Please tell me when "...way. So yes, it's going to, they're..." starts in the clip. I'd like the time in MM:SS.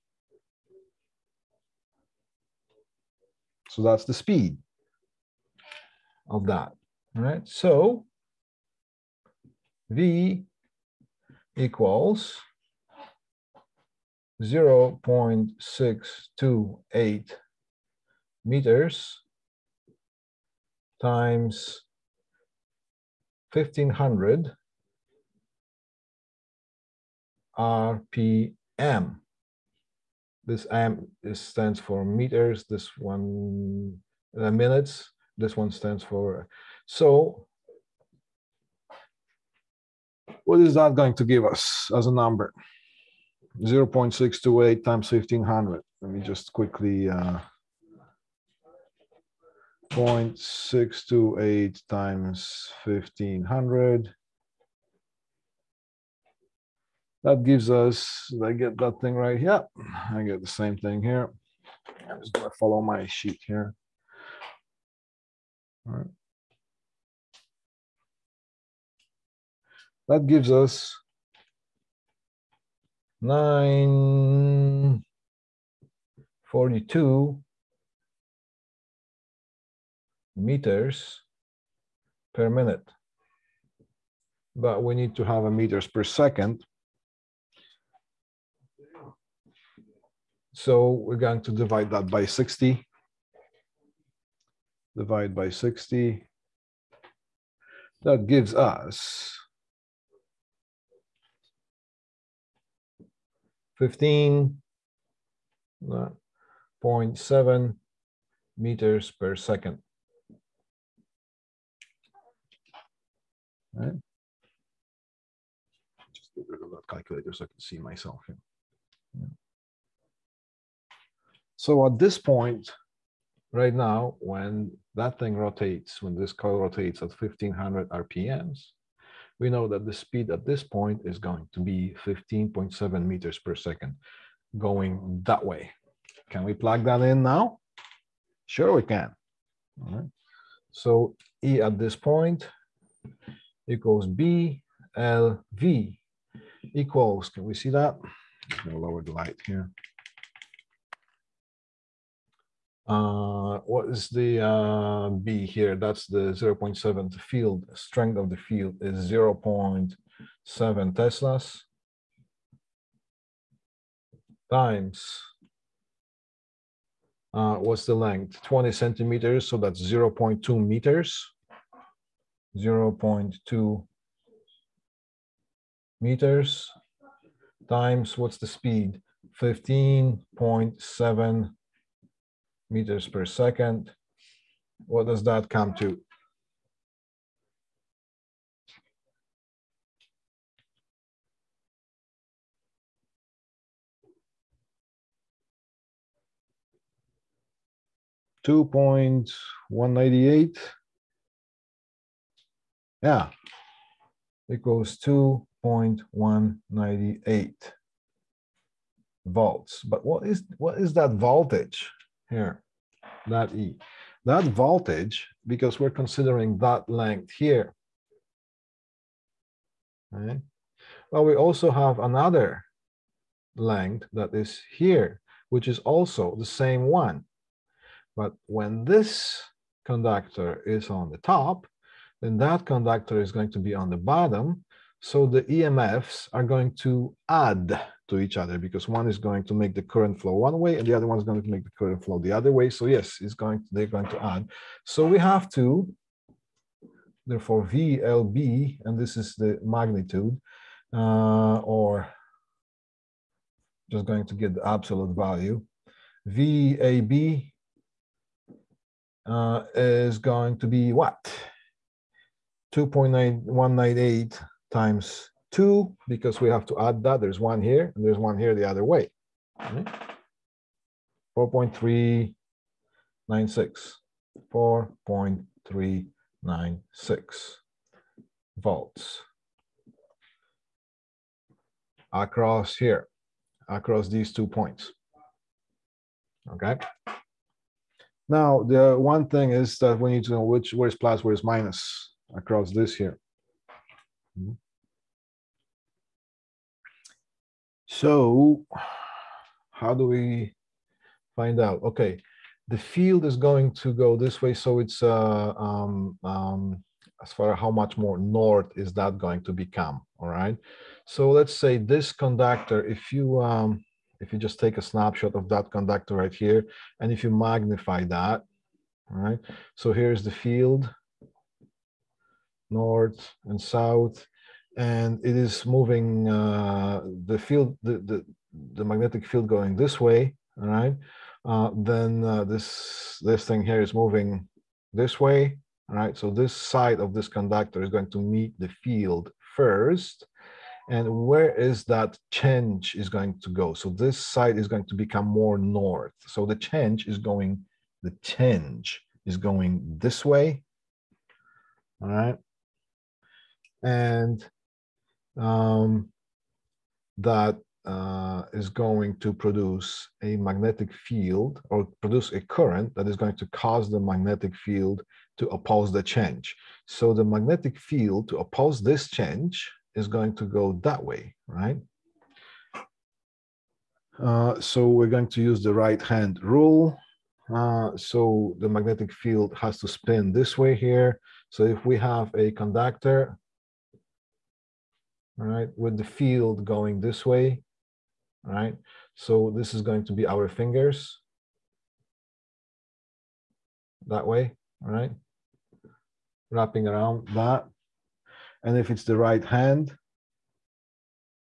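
04:02.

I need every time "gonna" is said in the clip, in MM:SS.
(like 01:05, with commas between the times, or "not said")
01:02, 02:28.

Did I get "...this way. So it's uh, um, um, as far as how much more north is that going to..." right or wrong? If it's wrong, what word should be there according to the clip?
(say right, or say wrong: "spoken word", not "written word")
right.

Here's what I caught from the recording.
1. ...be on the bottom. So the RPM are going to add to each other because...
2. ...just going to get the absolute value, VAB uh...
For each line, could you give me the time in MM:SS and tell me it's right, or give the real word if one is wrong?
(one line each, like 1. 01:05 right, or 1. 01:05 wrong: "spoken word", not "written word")
1. 03:53 wrong: "EMFs", not "RPM"
2. 04:13 right.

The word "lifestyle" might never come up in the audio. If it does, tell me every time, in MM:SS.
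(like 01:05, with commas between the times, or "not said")
not said.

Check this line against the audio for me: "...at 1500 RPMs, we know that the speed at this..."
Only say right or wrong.
right.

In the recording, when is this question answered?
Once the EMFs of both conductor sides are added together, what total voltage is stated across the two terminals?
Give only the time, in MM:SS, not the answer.
04:34.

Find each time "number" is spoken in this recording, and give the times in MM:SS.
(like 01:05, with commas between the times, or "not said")
00:42.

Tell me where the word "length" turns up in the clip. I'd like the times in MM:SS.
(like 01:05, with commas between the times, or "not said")
02:47, 03:36, 03:43.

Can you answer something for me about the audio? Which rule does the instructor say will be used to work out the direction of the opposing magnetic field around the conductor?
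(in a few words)
right hand rule.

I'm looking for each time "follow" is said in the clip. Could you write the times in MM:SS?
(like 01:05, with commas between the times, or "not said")
01:02.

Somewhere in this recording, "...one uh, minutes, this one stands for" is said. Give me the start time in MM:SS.
00:32.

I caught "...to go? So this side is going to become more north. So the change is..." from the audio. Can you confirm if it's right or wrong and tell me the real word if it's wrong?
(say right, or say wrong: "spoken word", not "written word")
right.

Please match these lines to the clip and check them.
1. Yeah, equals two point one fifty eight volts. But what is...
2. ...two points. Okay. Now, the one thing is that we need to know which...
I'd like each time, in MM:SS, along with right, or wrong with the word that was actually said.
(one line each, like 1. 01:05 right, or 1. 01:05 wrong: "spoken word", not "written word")
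1. 03:23 wrong: "ninety", not "fifty"
2. 04:44 right.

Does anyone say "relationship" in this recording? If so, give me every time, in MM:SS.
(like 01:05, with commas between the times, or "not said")
not said.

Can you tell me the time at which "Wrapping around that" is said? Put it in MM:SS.
06:36.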